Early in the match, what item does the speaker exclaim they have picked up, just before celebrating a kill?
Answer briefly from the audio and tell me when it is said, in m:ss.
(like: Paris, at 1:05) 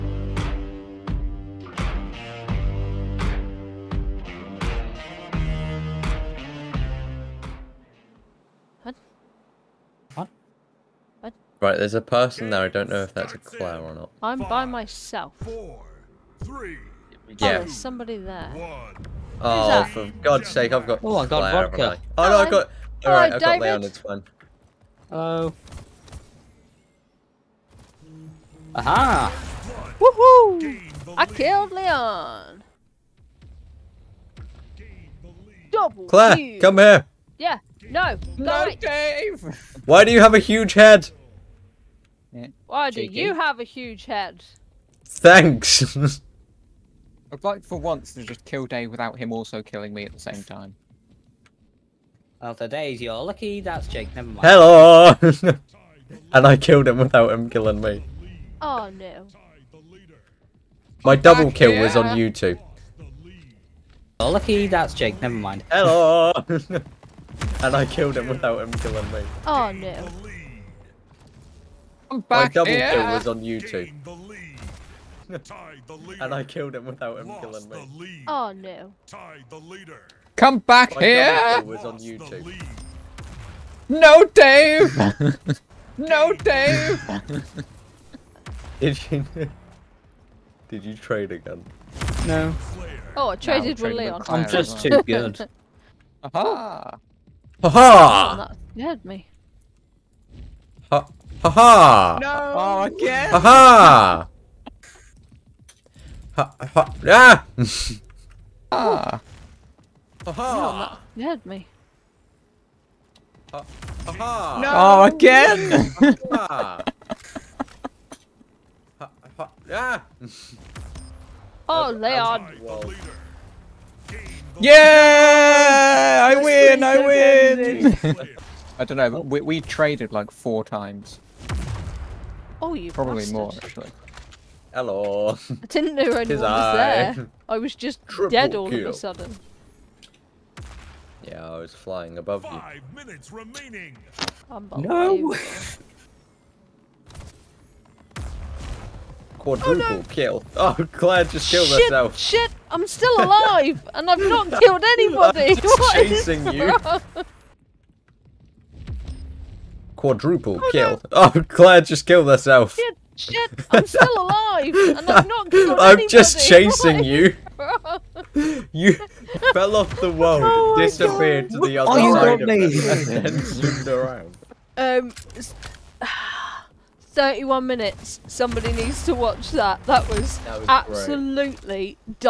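vodka, at 0:21.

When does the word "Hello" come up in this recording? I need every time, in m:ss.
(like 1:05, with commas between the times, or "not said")
0:54, 1:05, 2:14.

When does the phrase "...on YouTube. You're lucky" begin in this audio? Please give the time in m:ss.
1:01.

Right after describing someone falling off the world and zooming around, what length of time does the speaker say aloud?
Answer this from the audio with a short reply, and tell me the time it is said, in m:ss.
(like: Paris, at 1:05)
31 minutes, at 2:57.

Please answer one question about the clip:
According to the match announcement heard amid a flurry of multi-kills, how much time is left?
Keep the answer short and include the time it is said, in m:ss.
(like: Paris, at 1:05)
5 minutes, at 2:22.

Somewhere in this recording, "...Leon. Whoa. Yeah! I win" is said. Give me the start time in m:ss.
2:01.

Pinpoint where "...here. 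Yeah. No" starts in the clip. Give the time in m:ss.
0:36.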